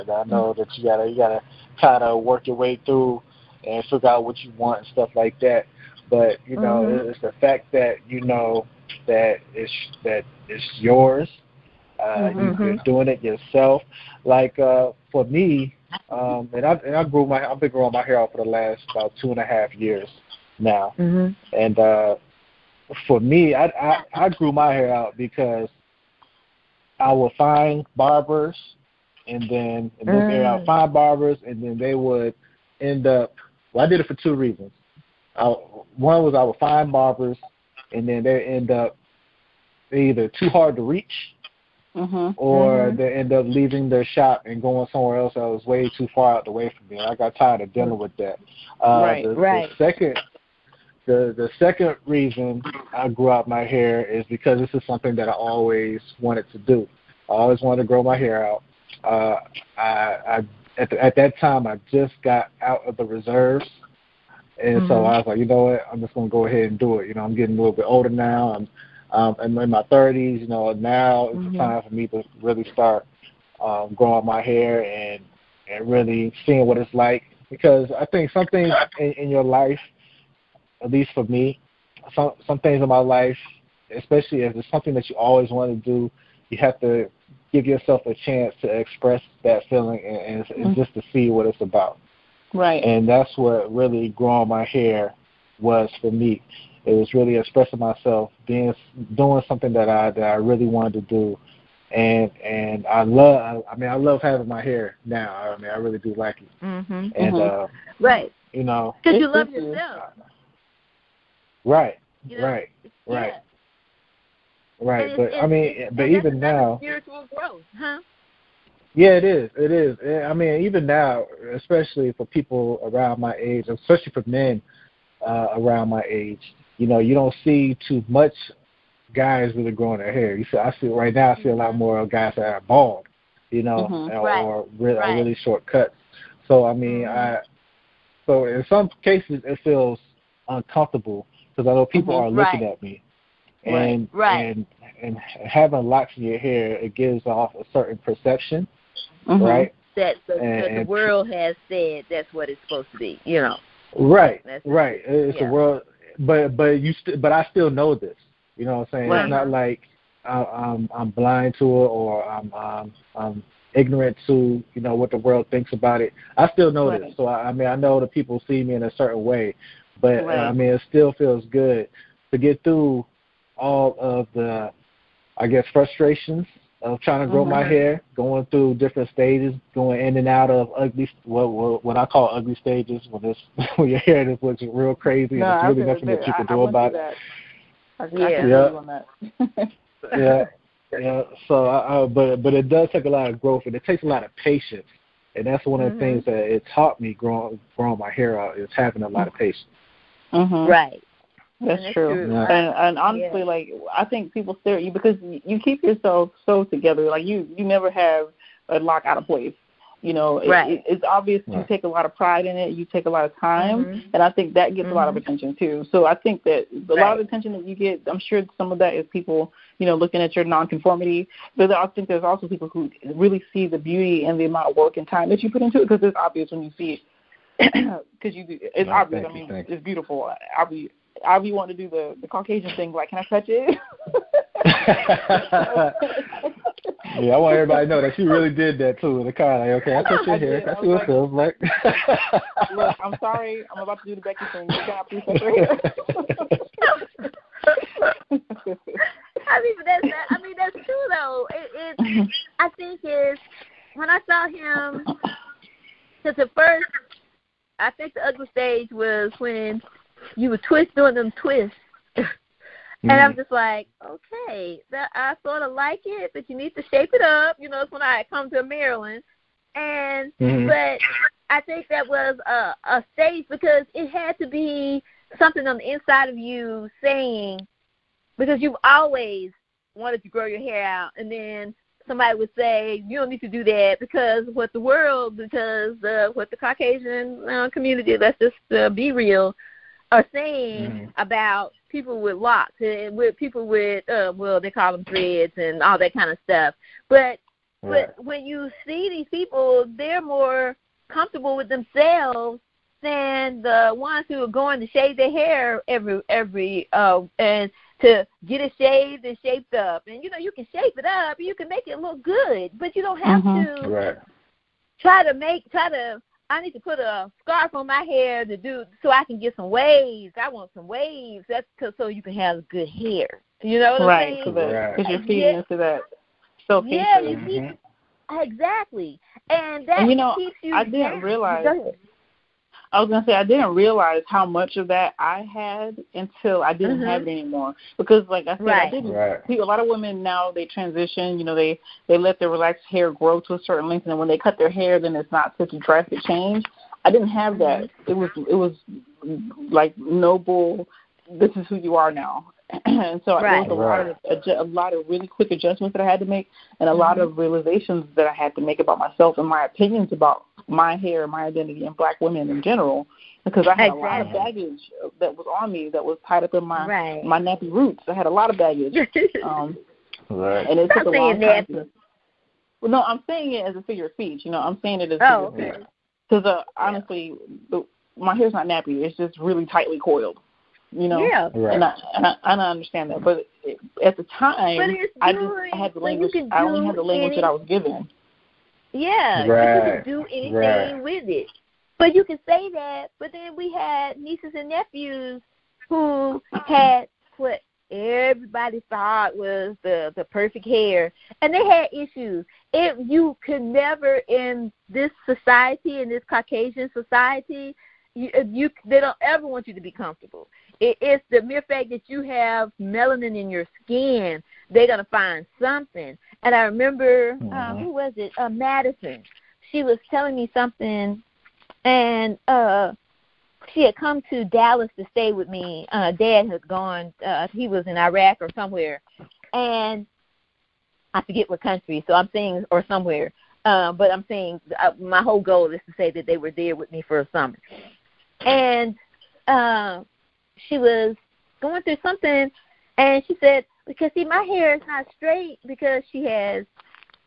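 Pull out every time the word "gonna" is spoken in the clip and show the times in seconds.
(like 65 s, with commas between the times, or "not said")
66 s, 333 s, 414 s.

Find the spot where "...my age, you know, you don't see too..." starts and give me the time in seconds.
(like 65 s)
125 s.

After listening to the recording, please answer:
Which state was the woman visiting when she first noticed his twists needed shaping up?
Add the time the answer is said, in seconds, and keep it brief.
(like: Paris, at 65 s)
Maryland, at 268 s.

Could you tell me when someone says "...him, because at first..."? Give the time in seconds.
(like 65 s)
254 s.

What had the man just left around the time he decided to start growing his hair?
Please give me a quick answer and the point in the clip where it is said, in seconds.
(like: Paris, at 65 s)
the reserves, at 62 s.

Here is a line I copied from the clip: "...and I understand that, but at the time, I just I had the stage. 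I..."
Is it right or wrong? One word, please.
wrong.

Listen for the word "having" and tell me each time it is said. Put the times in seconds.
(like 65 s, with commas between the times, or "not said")
104 s, 145 s, 198 s.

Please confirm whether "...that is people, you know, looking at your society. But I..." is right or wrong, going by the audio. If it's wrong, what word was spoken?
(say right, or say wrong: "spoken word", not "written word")
wrong: "nonconformity", not "society".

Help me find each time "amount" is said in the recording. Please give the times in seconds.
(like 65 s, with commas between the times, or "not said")
224 s.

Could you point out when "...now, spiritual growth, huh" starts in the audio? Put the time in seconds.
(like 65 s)
116 s.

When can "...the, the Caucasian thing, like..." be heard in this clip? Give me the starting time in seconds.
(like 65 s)
231 s.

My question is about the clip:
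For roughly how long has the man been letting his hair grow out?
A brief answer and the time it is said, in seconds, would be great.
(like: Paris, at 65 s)
2 and a half years, at 19 s.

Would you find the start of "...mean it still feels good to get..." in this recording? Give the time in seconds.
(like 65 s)
170 s.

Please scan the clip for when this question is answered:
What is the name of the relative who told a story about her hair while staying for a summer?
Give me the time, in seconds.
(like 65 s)
418 s.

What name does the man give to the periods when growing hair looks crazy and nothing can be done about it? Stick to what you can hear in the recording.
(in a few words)
ugly stages.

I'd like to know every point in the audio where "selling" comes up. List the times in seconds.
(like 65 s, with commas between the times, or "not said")
not said.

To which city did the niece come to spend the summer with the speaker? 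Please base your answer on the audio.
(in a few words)
Dallas.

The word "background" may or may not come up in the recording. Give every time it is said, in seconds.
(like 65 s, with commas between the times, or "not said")
not said.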